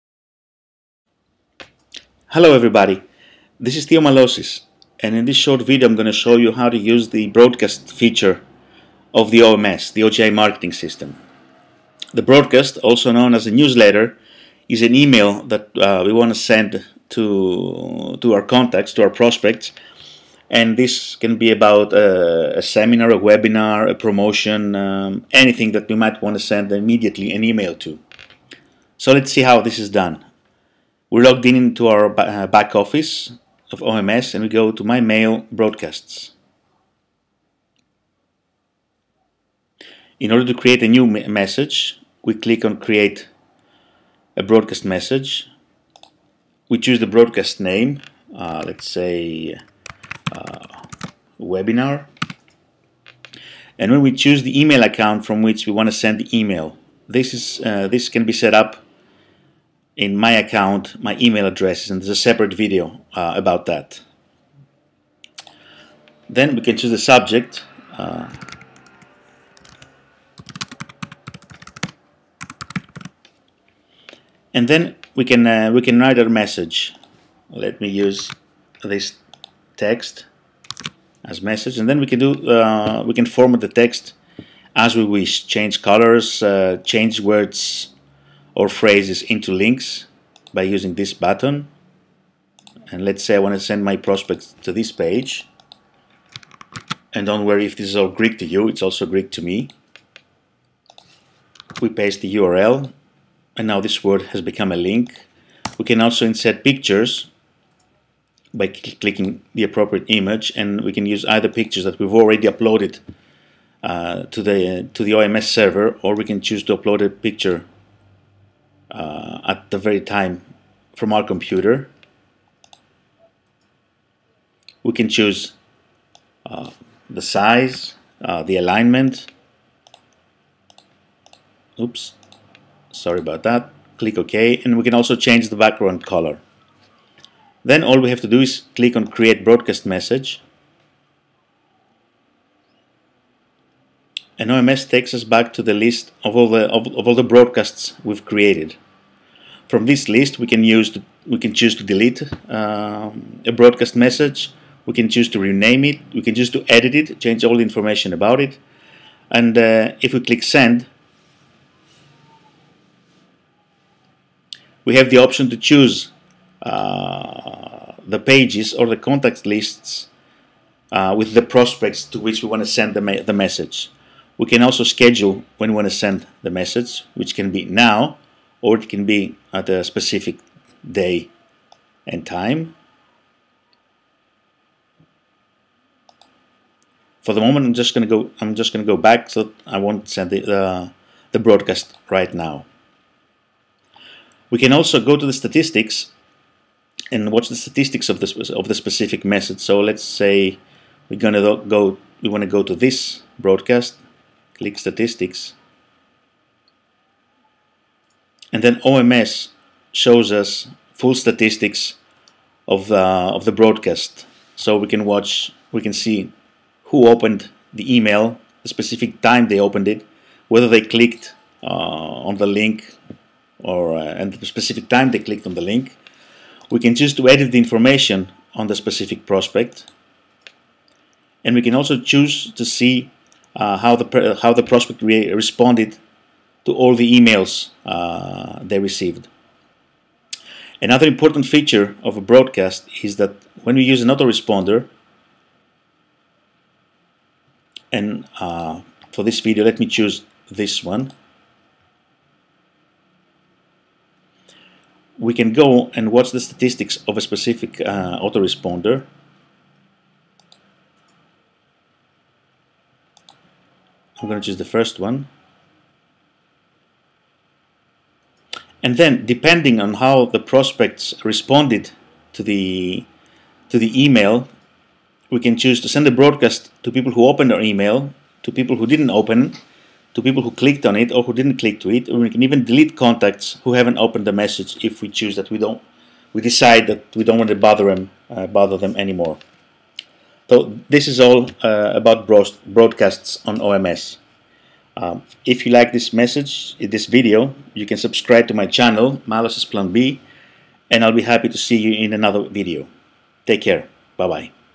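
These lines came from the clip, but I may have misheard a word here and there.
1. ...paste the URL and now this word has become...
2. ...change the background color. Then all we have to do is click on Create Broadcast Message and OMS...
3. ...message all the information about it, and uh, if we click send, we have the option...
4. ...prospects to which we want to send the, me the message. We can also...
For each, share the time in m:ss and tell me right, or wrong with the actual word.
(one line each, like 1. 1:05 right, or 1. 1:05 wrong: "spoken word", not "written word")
1. 1:41 right
2. 2:15 right
3. 2:37 wrong: "change", not "message"
4. 2:51 right.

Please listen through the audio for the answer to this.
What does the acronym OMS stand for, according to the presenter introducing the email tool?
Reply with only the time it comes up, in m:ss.
0:10.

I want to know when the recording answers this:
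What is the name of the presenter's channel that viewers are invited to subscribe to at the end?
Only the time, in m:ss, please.
4:59.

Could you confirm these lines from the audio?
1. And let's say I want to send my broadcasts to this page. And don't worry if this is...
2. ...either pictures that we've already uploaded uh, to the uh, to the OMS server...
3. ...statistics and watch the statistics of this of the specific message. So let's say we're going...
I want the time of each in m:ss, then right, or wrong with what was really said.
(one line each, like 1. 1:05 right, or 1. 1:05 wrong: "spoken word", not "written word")
1. 1:32 wrong: "prospects", not "broadcasts"
2. 1:51 right
3. 3:15 right.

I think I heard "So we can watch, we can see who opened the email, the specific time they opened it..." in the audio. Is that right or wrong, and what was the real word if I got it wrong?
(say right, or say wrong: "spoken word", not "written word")
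right.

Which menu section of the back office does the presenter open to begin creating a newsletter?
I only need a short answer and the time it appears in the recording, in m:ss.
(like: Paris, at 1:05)
My Mail Broadcasts, at 0:34.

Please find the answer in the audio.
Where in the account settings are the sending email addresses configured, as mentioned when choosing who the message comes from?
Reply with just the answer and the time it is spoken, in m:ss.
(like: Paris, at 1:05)
My email addresses, at 1:01.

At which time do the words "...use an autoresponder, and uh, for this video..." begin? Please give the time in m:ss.
4:03.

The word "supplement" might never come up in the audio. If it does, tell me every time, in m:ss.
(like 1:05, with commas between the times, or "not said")
not said.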